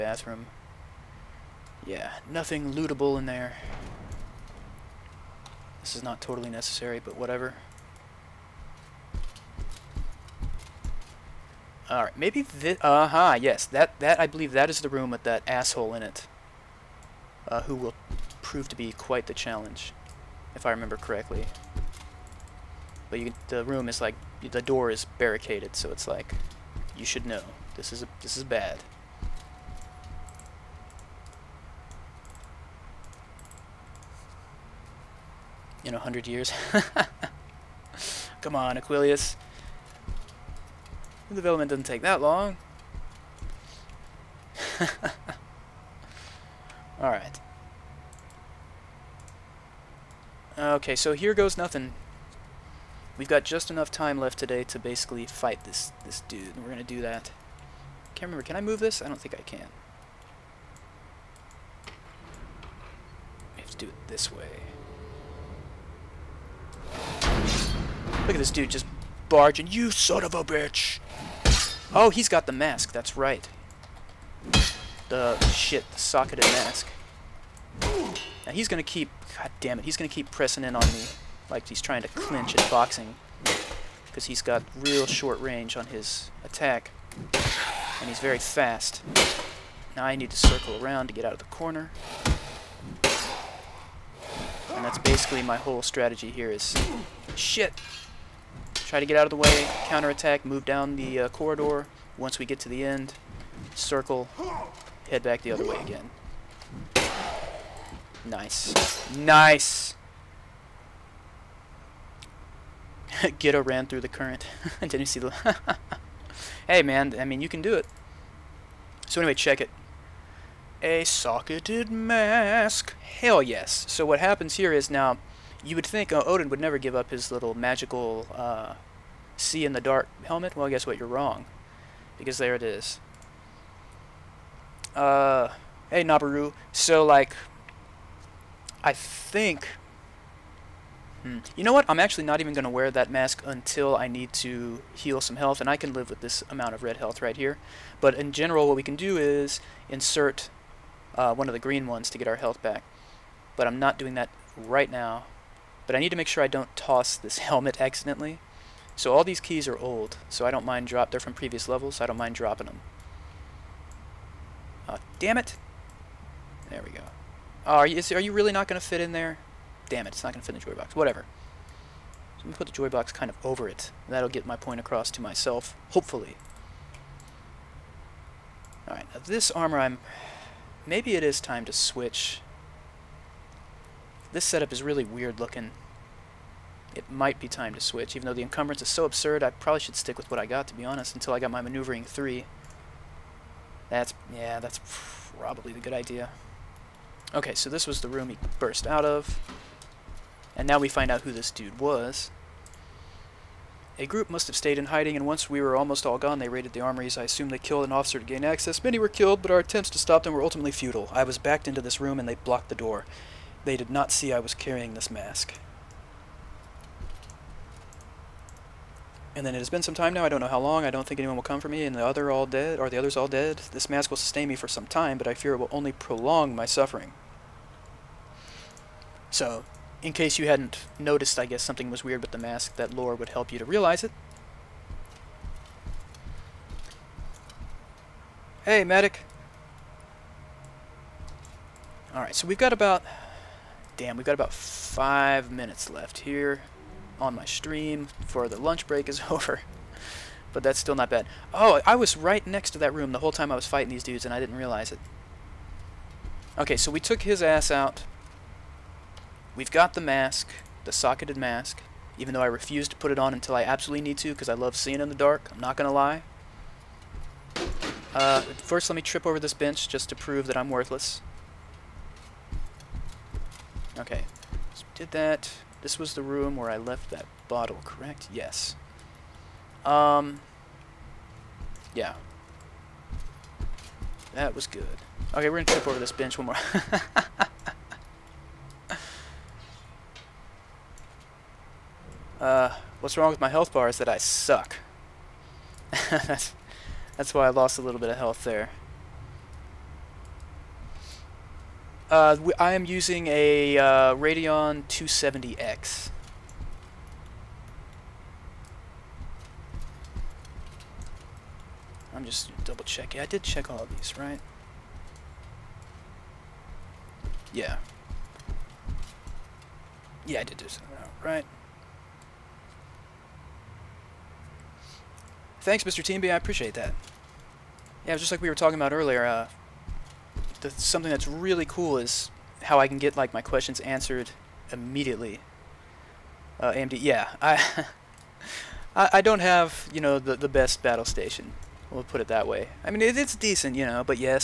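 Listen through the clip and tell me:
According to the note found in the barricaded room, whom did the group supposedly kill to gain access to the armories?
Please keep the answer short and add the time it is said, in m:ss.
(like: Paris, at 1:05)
An officer, at 3:27.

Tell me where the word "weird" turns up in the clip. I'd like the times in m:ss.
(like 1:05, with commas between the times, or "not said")
3:05, 3:52.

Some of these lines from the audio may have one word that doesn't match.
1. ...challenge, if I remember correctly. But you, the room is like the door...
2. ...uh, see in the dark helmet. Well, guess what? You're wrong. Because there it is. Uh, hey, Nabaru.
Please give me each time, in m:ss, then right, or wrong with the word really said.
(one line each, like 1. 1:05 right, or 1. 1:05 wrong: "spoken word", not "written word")
1. 0:19 right
2. 2:08 right.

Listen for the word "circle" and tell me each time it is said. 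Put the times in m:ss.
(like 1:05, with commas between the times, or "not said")
1:30, 1:43.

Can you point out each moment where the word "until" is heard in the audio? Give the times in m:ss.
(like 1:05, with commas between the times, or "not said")
2:23, 3:11, 4:23.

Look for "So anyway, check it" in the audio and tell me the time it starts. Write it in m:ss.
1:59.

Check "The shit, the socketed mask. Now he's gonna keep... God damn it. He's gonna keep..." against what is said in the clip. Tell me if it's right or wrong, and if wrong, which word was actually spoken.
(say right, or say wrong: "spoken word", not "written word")
right.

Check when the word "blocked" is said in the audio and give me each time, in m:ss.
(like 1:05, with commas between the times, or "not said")
3:32.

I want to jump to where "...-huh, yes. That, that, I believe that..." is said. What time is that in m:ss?
0:13.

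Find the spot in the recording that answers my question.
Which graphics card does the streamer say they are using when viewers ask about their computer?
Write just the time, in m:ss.
5:04.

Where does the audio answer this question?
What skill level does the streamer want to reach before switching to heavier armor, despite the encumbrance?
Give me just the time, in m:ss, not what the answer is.
3:11.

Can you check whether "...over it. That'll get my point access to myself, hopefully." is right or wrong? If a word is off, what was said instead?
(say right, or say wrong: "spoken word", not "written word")
wrong: "across", not "access".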